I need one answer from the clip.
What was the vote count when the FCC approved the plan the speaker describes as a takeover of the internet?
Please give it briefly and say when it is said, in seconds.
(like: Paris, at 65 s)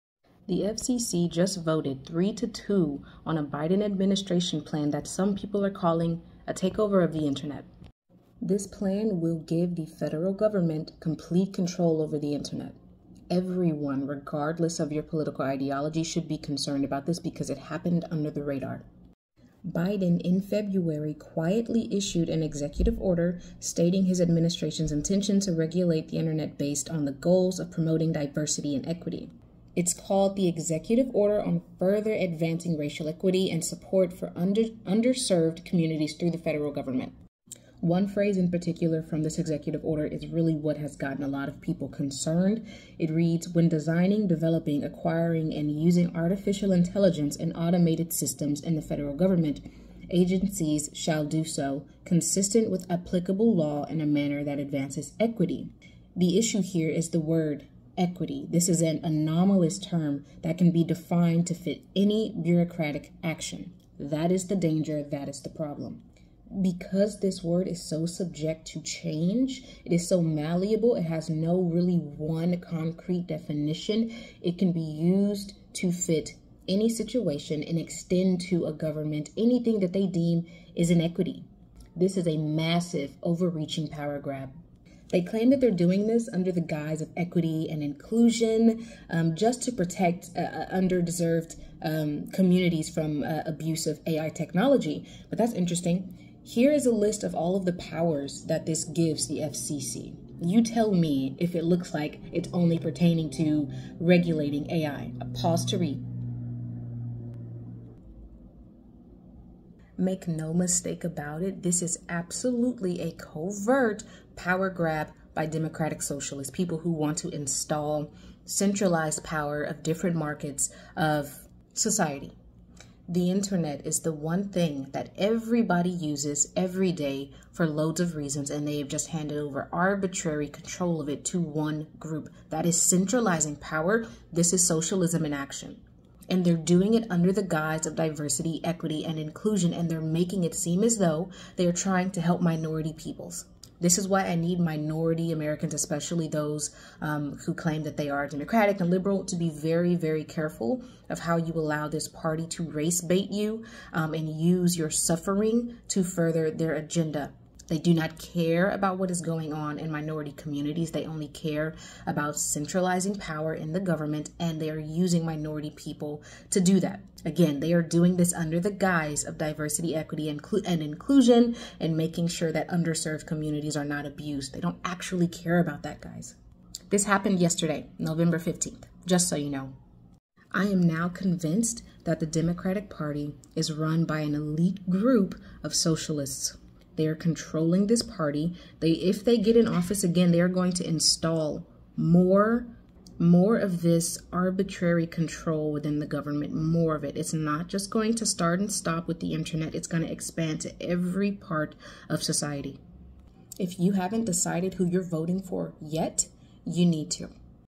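3 to 2, at 2 s.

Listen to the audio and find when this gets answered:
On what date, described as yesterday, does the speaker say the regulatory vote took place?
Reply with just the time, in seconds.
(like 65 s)
177 s.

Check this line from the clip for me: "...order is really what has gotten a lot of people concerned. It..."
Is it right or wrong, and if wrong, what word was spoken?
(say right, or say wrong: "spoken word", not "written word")
right.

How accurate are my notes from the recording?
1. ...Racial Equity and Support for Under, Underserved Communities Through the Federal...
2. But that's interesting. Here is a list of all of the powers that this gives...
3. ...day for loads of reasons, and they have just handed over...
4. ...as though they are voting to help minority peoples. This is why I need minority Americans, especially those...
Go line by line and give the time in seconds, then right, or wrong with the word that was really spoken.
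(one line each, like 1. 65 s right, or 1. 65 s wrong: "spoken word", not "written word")
1. 32 s right
2. 95 s right
3. 126 s right
4. 140 s wrong: "trying", not "voting".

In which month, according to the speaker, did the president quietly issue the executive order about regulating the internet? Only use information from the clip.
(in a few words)
February.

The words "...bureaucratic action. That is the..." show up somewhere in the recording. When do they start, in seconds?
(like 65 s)
62 s.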